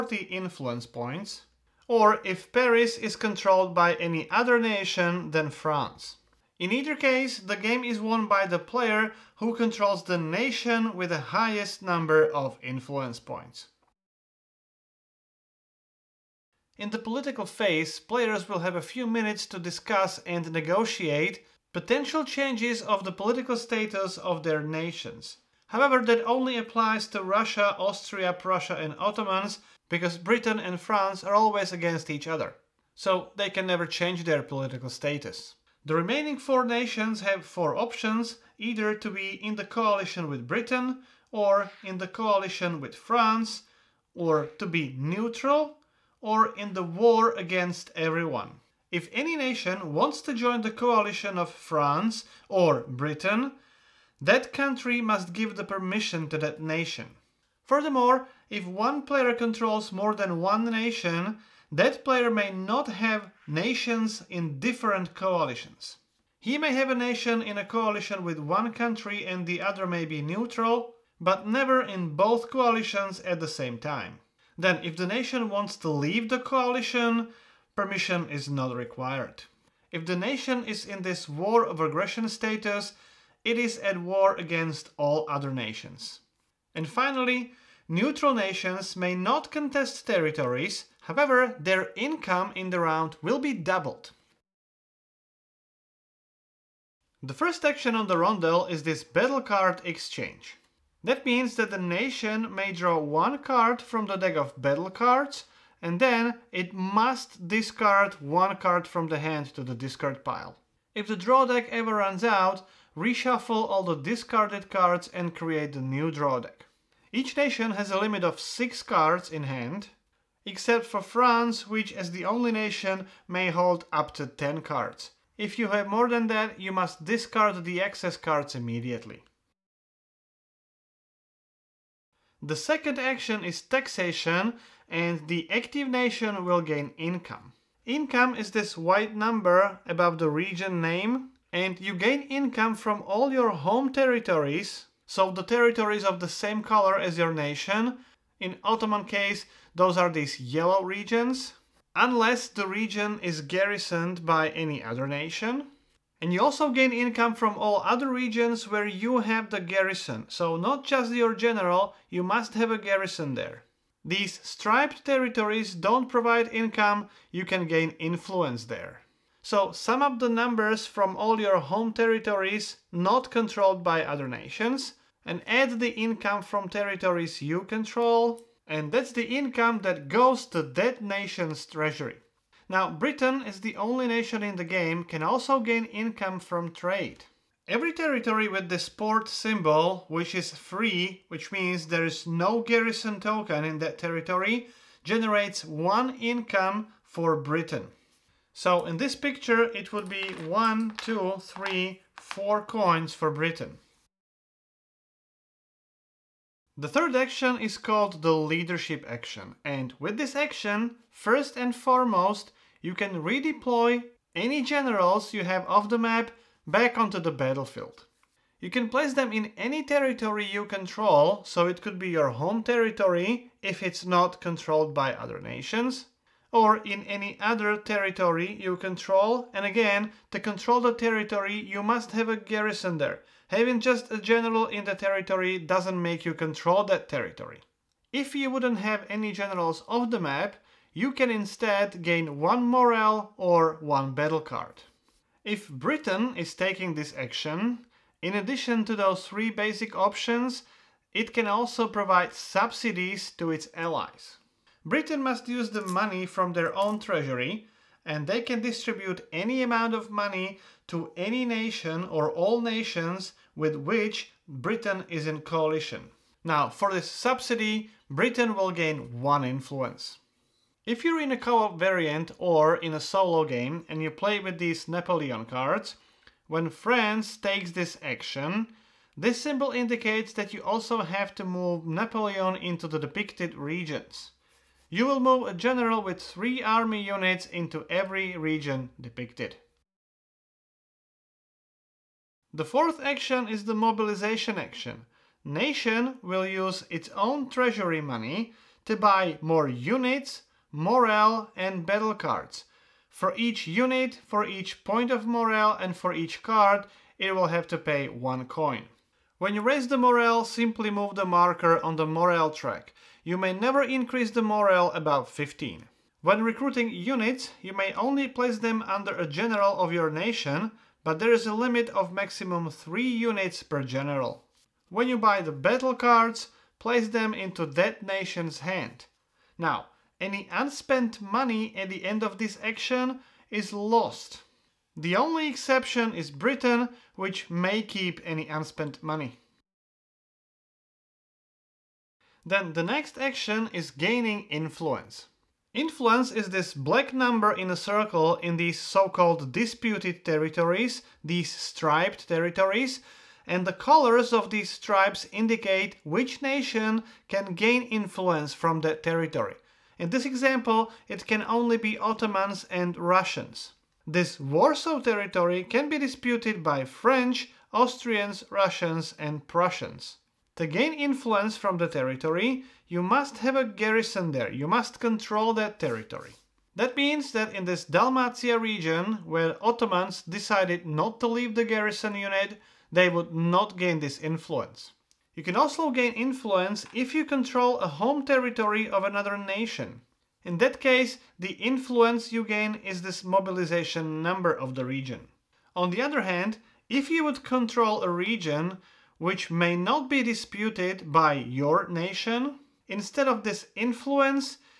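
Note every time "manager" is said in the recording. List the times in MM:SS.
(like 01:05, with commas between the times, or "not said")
not said.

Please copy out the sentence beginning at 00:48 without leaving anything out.
If any nation wants to join the coalition of France or Britain, that country must give the permission to that nation.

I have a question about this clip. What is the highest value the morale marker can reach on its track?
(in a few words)
15.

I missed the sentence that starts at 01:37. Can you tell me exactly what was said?
The first action on the rondel is this battle card exchange.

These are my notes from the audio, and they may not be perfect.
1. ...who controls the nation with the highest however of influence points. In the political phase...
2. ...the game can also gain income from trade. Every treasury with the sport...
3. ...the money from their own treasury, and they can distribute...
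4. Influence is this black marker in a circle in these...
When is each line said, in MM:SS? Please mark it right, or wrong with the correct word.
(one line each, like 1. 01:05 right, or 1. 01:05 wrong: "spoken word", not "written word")
1. 00:09 wrong: "number", not "however"
2. 03:04 wrong: "territory", not "treasury"
3. 04:15 right
4. 05:45 wrong: "number", not "marker".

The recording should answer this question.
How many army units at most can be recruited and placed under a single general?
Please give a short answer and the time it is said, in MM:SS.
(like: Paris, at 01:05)
3, at 05:22.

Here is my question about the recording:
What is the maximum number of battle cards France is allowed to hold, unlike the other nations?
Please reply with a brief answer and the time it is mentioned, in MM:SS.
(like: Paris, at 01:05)
10, at 02:04.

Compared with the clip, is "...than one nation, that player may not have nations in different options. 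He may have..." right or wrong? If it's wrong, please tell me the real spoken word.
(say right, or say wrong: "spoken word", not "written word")
wrong: "coalitions", not "options".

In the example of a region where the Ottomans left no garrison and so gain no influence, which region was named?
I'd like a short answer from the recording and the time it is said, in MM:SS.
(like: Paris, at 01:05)
Dalmatia, at 06:17.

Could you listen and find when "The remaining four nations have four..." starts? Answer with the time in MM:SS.
00:35.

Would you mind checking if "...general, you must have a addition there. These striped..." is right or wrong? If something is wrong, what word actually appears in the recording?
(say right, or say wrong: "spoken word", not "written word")
wrong: "garrison", not "addition".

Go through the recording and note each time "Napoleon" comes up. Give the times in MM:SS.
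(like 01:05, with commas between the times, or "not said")
04:34, 04:41.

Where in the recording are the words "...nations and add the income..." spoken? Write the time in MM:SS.
02:54.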